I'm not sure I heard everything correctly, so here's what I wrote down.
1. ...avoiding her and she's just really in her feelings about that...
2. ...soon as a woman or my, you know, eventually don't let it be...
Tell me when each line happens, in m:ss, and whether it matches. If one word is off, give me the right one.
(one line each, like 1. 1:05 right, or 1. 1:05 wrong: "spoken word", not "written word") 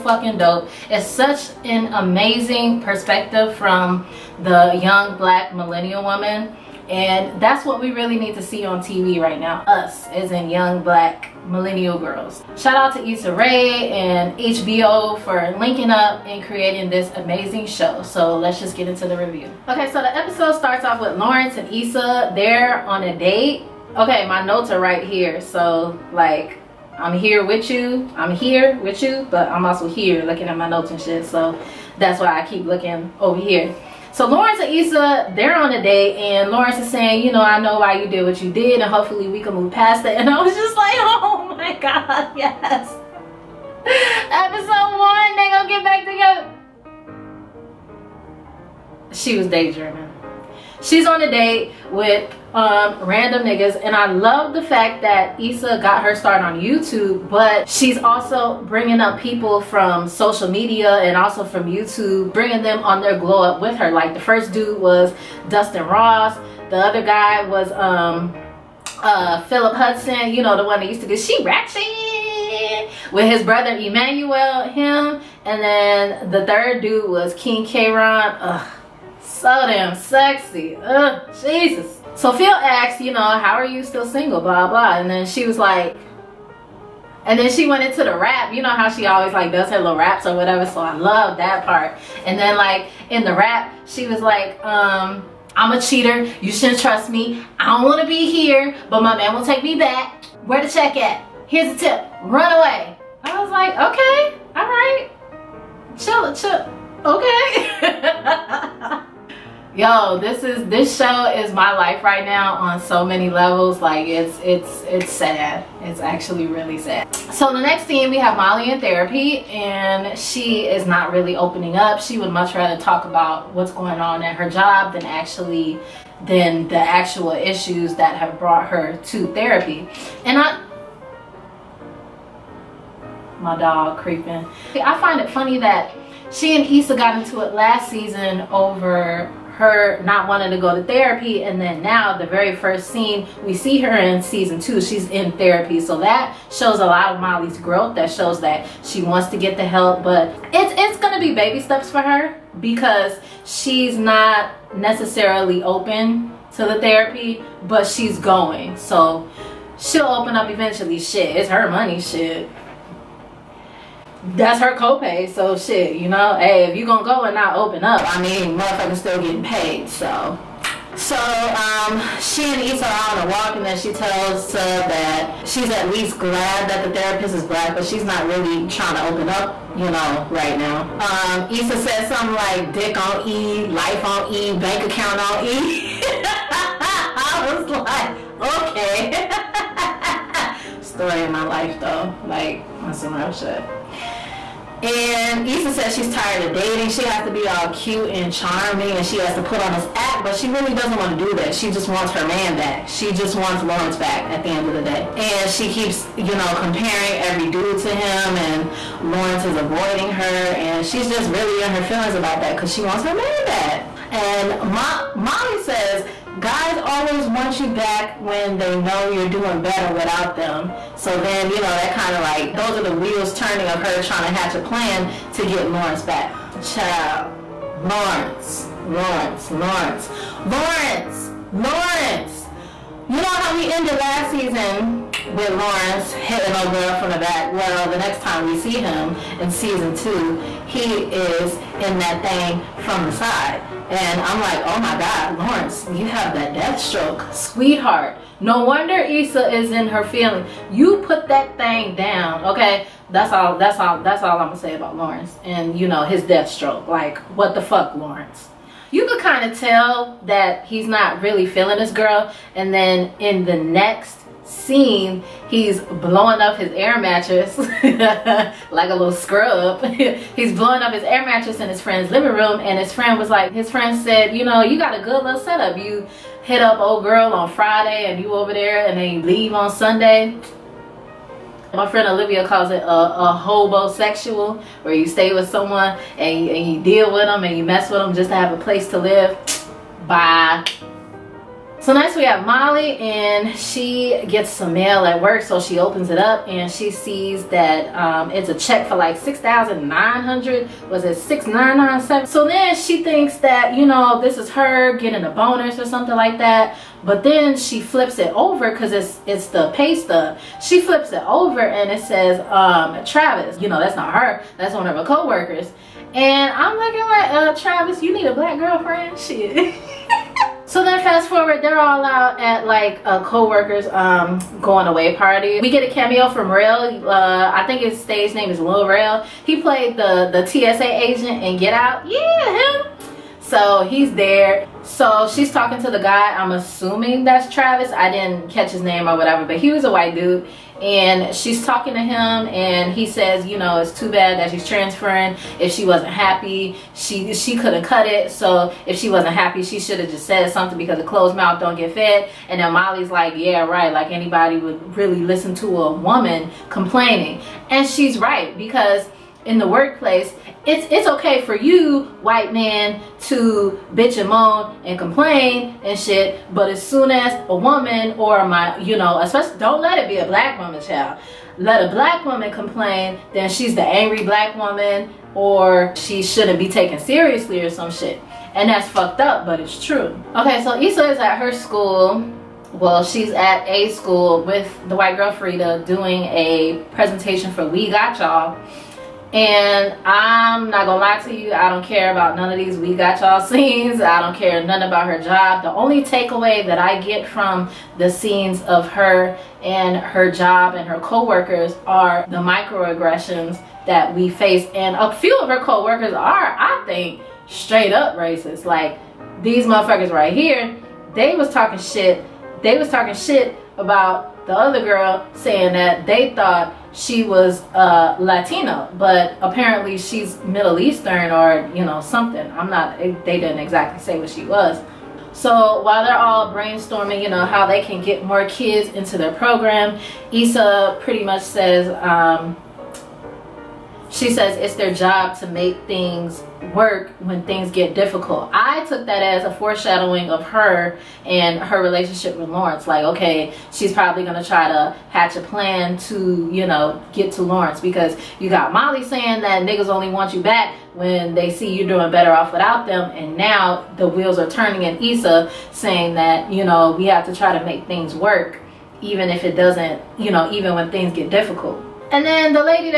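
1. 3:29 right
2. 6:06 wrong: "especially", not "eventually".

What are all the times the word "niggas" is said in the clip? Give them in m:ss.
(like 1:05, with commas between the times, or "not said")
0:53, 7:29.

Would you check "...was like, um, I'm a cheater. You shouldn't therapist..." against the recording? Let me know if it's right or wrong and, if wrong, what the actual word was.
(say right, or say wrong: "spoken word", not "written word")
wrong: "trust", not "therapist".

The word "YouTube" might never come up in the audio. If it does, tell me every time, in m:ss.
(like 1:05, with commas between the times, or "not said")
0:56, 1:01.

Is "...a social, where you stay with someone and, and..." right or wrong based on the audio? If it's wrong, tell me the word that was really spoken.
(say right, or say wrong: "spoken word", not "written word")
wrong: "sexual", not "social".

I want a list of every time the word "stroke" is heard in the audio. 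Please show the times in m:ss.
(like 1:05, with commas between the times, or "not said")
4:06, 4:16.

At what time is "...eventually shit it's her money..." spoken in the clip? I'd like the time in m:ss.
2:40.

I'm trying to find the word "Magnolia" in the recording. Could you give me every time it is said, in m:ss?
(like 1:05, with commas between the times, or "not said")
not said.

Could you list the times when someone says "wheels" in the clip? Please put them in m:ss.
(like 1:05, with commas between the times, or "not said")
3:42, 7:34.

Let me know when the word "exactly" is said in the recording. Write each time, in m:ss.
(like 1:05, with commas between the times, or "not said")
7:03.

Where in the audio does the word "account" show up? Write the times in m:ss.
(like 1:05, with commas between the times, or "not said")
3:04.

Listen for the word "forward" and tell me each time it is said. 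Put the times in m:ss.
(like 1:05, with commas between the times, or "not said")
5:21.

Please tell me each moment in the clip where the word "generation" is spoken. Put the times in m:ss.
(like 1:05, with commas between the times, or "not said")
not said.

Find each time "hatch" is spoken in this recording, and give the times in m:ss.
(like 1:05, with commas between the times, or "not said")
3:44, 7:25.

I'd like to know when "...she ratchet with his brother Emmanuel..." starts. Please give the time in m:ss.
1:11.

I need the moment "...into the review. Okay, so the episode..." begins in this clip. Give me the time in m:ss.
0:18.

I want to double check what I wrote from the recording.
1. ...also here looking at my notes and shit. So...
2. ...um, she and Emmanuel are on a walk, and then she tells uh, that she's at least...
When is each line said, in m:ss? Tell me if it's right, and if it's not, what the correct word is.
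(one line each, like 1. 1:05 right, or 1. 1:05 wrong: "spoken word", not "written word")
1. 0:29 right
2. 2:51 wrong: "Issa", not "Emmanuel".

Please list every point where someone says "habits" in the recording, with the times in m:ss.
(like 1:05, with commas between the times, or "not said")
not said.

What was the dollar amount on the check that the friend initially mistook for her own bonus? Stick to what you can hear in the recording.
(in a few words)
6997.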